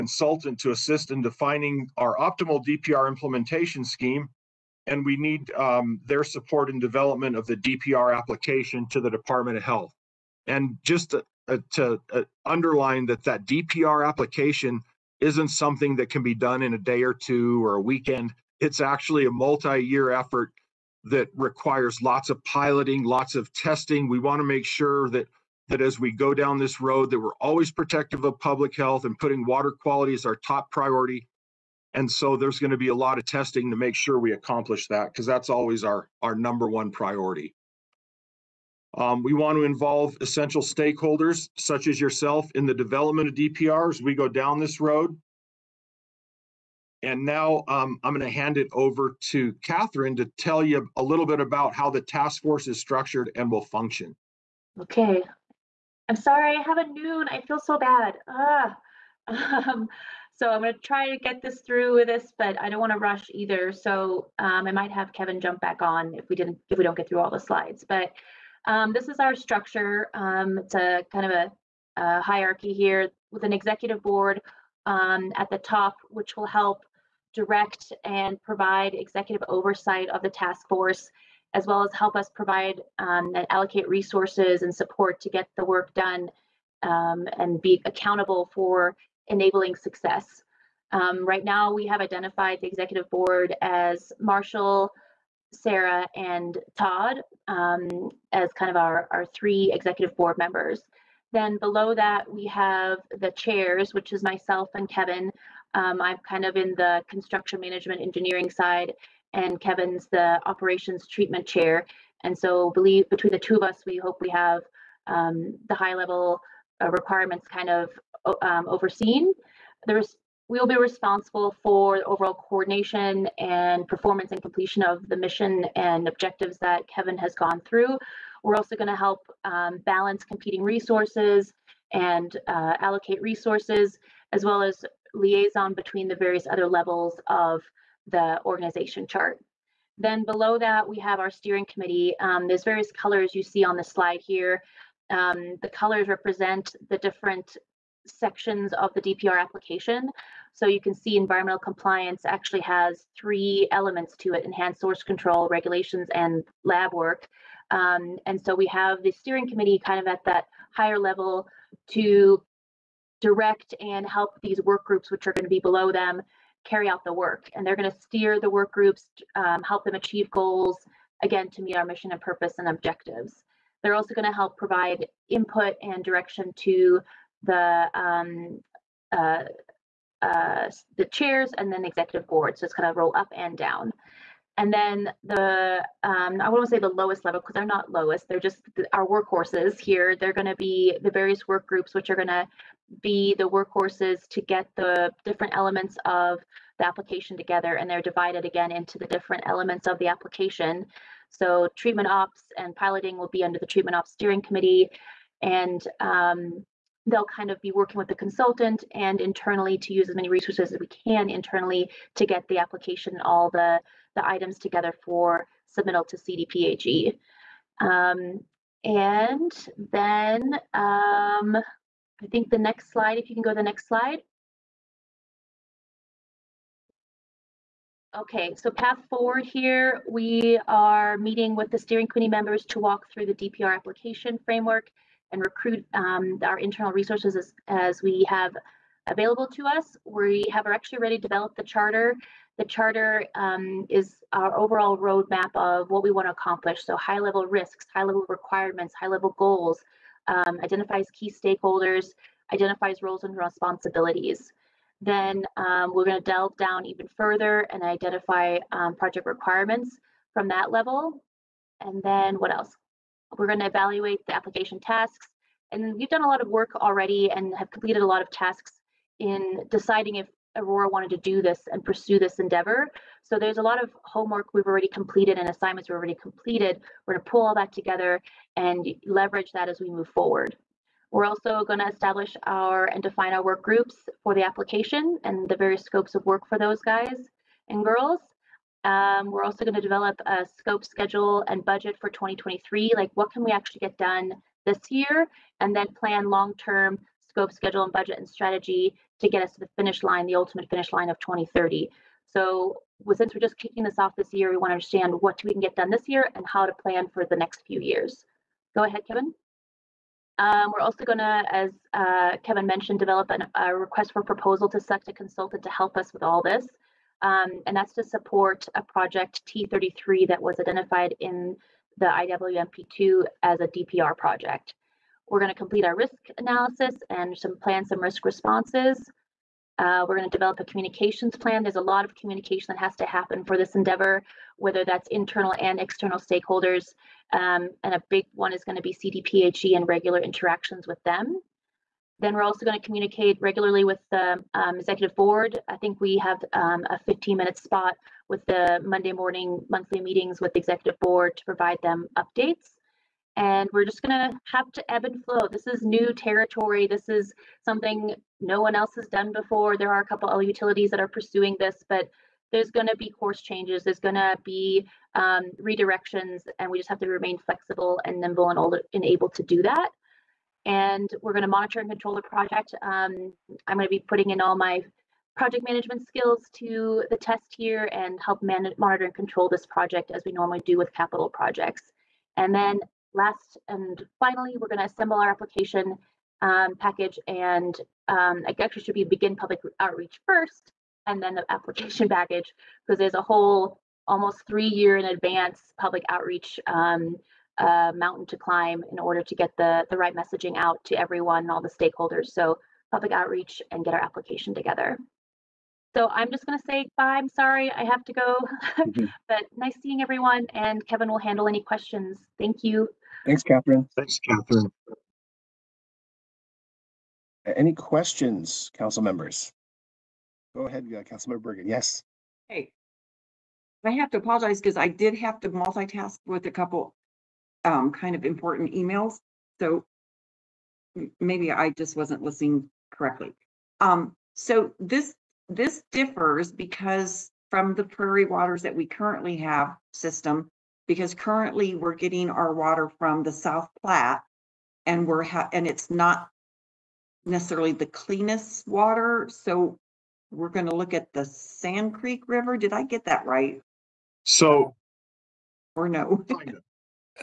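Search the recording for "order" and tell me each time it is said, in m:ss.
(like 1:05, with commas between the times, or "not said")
6:38.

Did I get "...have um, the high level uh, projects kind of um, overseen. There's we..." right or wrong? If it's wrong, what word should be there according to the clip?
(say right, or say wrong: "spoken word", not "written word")
wrong: "requirements", not "projects".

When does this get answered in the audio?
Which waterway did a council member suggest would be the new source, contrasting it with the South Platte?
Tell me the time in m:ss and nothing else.
7:31.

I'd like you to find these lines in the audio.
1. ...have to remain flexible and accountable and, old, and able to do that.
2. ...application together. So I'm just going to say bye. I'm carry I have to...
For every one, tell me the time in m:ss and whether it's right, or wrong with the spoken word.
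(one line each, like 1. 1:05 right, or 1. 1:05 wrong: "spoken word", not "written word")
1. 6:06 wrong: "nimble", not "accountable"
2. 6:44 wrong: "sorry", not "carry".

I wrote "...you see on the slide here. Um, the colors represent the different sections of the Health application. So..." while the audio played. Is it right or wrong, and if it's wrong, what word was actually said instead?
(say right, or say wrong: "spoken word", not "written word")
wrong: "DPR", not "Health".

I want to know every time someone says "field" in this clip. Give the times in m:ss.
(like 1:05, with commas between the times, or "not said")
not said.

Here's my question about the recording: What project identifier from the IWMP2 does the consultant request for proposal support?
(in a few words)
T33.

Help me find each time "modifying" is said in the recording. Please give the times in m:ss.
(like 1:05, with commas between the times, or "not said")
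not said.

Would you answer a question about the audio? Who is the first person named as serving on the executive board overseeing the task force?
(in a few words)
Marshall.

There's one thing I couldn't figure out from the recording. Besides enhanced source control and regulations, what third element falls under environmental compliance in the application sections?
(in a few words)
lab work.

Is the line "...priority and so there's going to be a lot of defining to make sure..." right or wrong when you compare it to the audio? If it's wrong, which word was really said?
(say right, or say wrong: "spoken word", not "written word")
wrong: "testing", not "defining".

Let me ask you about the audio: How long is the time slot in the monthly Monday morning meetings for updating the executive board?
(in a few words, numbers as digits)
15 minutes.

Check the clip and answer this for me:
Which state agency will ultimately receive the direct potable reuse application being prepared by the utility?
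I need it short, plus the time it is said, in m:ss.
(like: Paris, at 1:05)
Department of Health, at 0:09.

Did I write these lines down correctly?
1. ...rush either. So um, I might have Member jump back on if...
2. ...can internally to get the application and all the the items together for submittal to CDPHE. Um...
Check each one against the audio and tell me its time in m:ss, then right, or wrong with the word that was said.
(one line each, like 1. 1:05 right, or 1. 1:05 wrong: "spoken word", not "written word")
1. 1:02 wrong: "Kevin", not "Member"
2. 3:30 right.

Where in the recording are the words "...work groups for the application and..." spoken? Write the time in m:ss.
4:43.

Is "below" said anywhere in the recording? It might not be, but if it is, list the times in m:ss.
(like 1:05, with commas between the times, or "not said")
1:41, 2:20, 2:45.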